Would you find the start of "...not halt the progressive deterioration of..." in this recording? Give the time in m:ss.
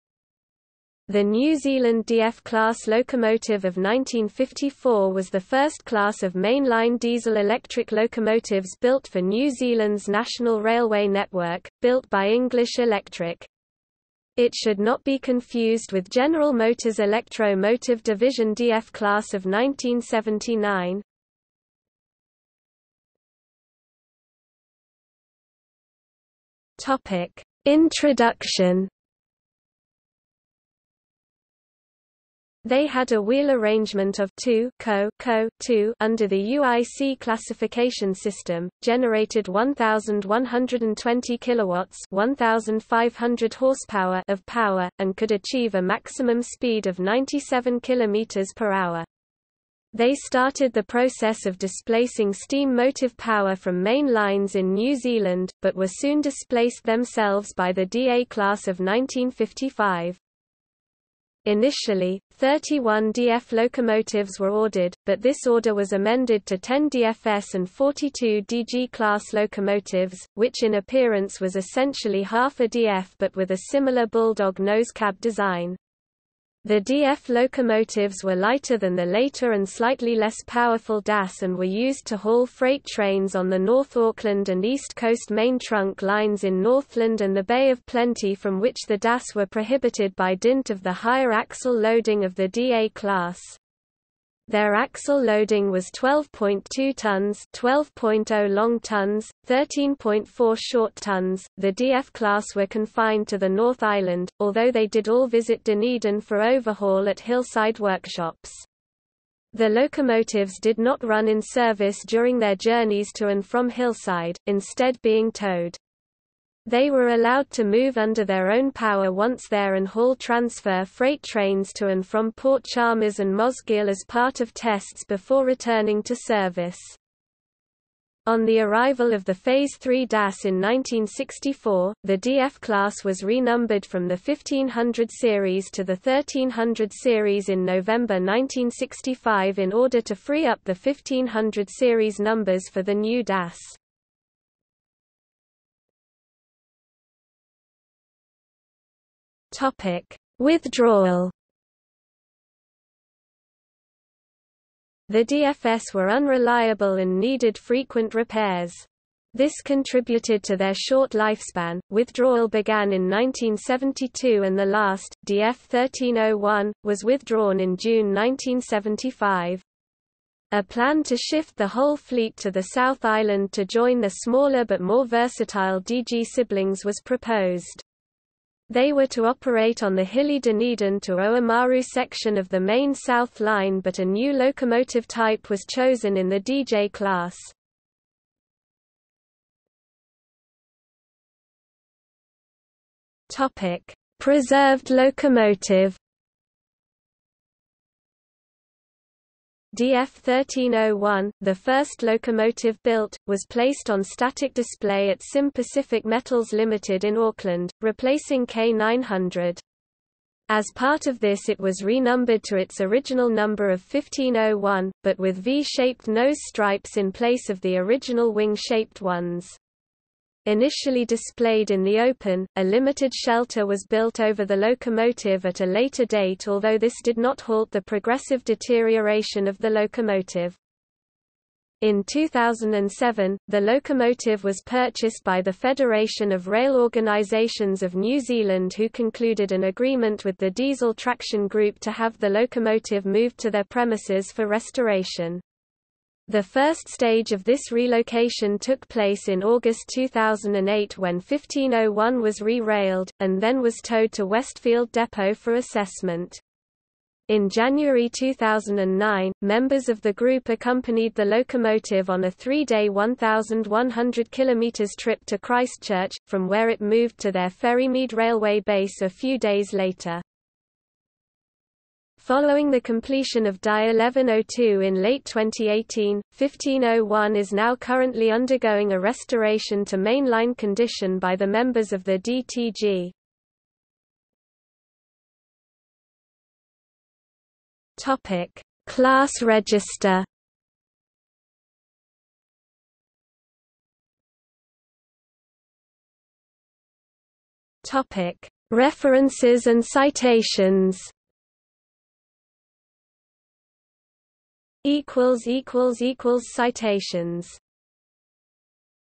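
3:47.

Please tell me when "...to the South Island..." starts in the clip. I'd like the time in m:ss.
2:52.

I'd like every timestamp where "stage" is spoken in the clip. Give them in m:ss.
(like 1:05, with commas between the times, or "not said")
4:06.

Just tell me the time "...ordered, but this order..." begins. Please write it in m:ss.
1:04.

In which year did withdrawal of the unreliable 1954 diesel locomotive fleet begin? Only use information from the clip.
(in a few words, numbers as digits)
1972.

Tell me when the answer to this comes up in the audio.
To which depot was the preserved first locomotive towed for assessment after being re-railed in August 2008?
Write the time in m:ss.
4:14.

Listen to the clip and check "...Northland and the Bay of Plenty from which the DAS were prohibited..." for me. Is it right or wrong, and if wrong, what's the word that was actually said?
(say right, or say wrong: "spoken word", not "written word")
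right.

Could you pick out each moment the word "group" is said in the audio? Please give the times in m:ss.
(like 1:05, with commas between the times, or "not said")
4:01, 4:20.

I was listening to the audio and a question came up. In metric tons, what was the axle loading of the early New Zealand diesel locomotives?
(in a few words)
12.2 tons.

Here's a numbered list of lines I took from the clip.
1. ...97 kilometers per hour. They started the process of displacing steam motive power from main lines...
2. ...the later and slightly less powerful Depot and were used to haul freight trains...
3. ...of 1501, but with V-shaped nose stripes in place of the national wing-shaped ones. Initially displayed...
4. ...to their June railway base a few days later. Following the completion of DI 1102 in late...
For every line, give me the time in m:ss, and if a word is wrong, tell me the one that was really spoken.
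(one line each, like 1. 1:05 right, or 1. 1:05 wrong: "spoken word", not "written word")
1. 0:46 right
2. 1:18 wrong: "DAS", not "Depot"
3. 3:33 wrong: "original", not "national"
4. 4:27 wrong: "Ferrymead", not "June".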